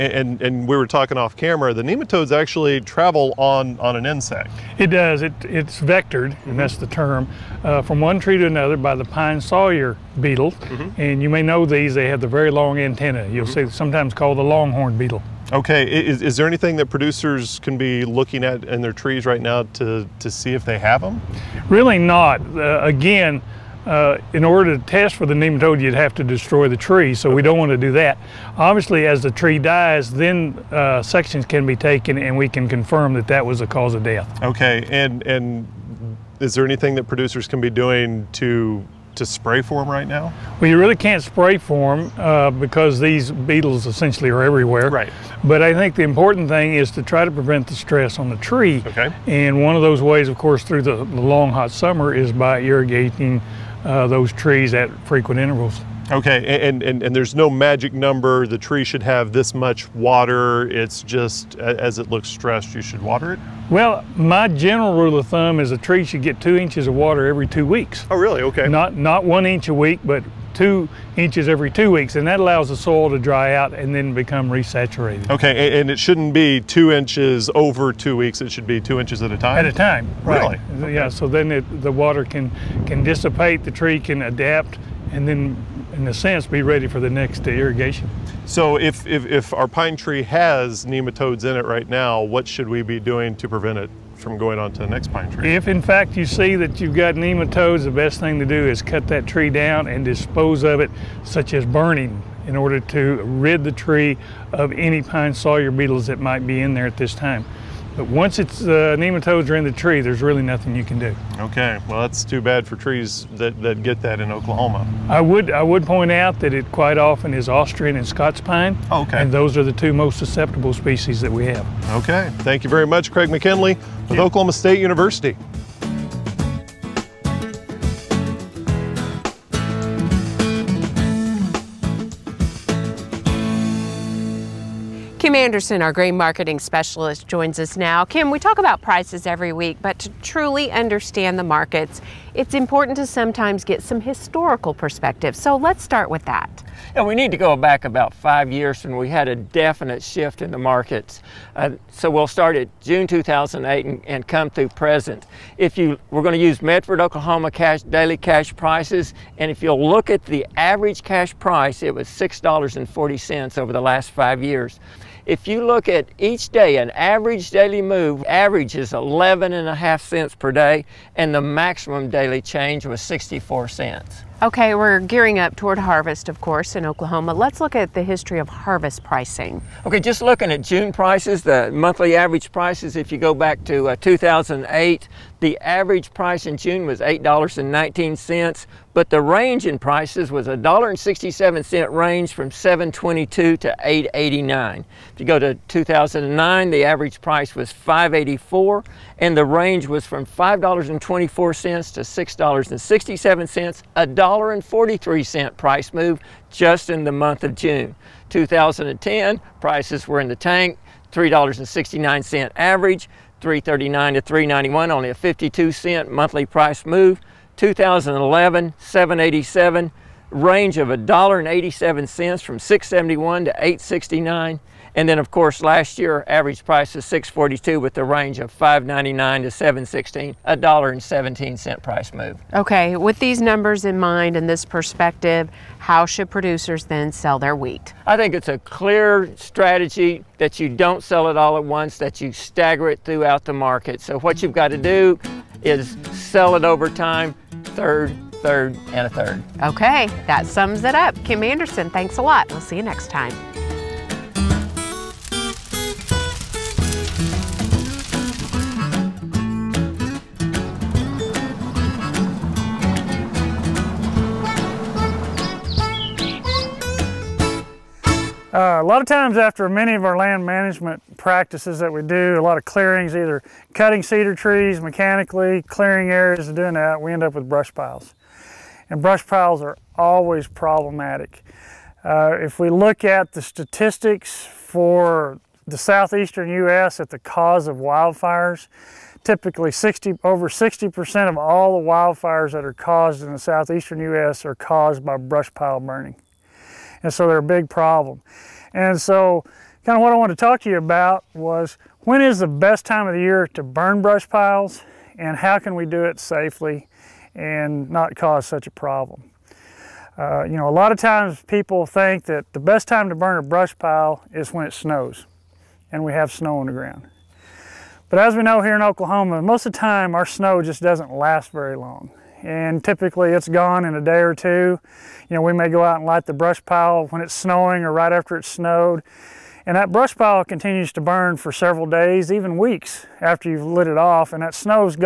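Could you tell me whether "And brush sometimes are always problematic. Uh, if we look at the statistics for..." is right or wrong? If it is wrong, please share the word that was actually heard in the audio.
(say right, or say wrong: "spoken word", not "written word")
wrong: "piles", not "sometimes".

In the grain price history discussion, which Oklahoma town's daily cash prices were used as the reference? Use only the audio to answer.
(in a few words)
Medford.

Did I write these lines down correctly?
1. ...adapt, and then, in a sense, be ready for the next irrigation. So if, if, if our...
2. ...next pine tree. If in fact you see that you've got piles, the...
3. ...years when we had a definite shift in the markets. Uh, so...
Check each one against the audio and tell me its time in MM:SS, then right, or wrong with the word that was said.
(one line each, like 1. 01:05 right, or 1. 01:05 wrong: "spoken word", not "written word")
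1. 01:24 right
2. 01:34 wrong: "nematodes", not "piles"
3. 02:28 right.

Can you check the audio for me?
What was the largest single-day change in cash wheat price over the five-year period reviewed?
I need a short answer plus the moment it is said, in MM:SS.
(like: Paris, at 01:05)
64 cents, at 02:53.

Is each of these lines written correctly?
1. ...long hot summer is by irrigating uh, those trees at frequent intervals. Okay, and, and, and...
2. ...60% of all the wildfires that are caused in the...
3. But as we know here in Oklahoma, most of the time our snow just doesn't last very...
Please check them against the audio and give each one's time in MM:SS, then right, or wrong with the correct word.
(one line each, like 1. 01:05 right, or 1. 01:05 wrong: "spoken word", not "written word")
1. 00:51 right
2. 04:50 right
3. 05:18 right.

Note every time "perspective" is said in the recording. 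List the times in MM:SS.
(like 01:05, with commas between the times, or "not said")
02:24, 03:54.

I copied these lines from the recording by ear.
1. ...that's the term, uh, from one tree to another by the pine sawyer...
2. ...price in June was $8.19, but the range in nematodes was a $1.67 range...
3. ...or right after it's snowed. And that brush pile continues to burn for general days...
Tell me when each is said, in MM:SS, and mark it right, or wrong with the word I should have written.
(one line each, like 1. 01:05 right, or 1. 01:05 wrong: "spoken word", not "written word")
1. 00:06 right
2. 03:06 wrong: "prices", not "nematodes"
3. 05:27 wrong: "several", not "general".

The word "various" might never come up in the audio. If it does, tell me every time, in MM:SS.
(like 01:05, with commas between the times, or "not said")
not said.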